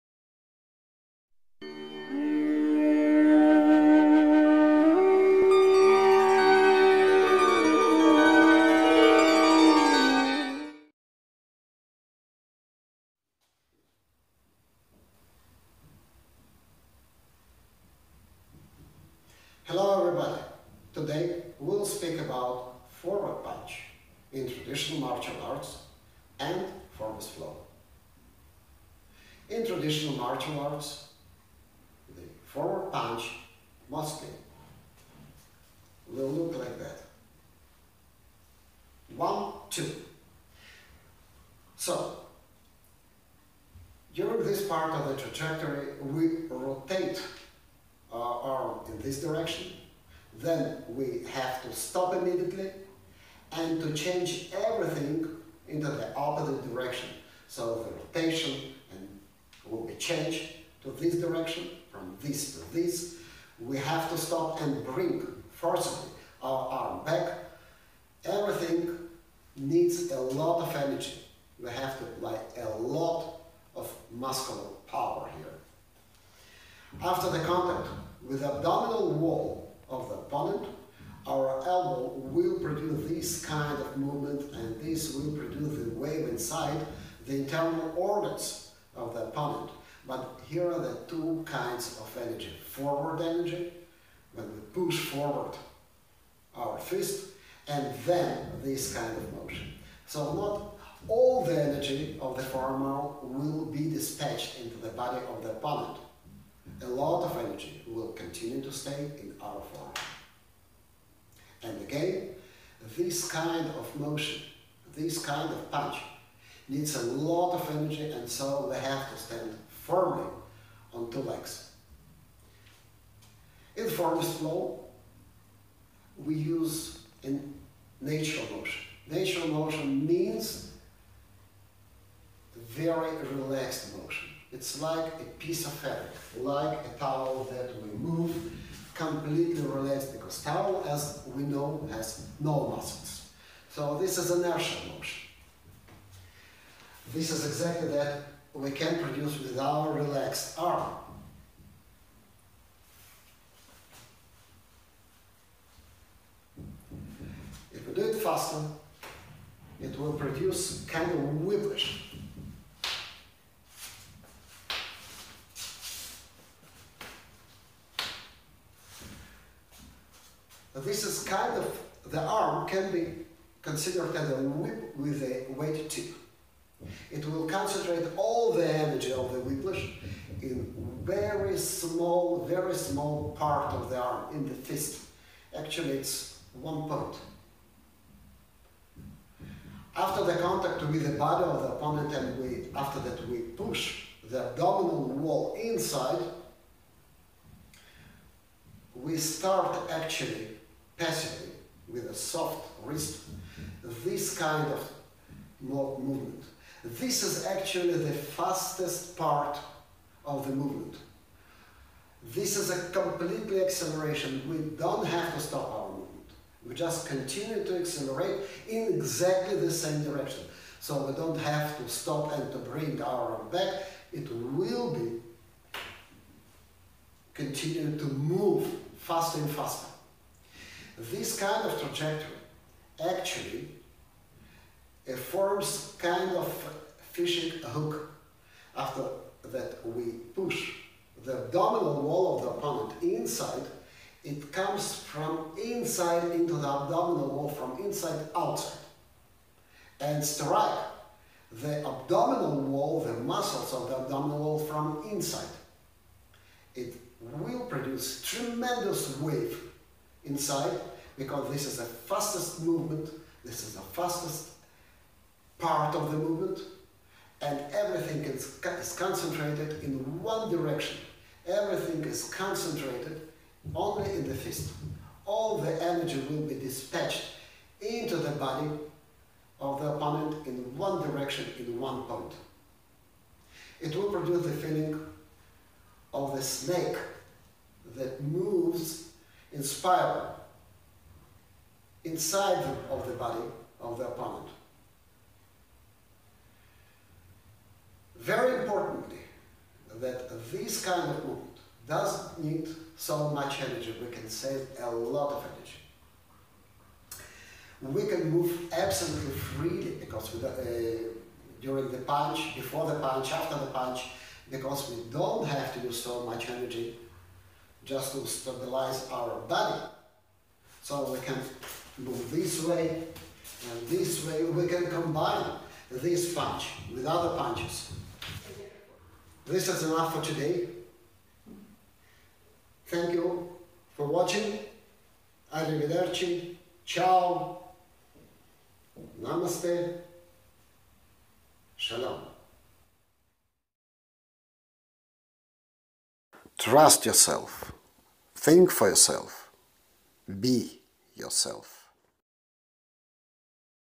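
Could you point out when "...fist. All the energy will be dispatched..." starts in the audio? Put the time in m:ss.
4:34.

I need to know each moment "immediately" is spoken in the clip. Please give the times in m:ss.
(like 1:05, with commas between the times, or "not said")
0:52.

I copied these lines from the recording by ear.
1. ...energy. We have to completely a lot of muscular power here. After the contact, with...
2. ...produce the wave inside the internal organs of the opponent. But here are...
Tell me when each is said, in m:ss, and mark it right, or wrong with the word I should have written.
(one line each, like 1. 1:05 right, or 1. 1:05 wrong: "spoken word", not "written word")
1. 1:10 wrong: "apply", not "completely"
2. 1:25 right.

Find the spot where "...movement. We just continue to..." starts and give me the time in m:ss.
3:35.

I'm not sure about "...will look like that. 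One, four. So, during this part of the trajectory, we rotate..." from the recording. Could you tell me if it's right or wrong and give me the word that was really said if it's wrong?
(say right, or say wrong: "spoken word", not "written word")
wrong: "two", not "four".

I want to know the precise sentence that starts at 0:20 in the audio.
Today we'll speak about forward punch in traditional martial arts and Formless Flow.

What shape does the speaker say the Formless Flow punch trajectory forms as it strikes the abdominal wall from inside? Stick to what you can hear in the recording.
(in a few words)
Fishing hook.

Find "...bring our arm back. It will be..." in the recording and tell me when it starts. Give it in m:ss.
3:42.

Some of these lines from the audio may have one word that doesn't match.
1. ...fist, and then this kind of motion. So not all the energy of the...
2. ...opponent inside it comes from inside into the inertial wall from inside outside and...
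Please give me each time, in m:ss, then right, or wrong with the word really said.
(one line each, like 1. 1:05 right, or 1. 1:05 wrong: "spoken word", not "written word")
1. 1:36 right
2. 4:02 wrong: "abdominal", not "inertial".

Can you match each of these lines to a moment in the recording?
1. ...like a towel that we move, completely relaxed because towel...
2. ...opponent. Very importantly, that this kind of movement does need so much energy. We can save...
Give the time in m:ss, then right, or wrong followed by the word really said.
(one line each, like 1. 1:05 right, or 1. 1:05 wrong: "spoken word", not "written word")
1. 2:16 right
2. 4:54 right.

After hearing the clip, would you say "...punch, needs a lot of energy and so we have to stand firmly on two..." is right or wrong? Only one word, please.
right.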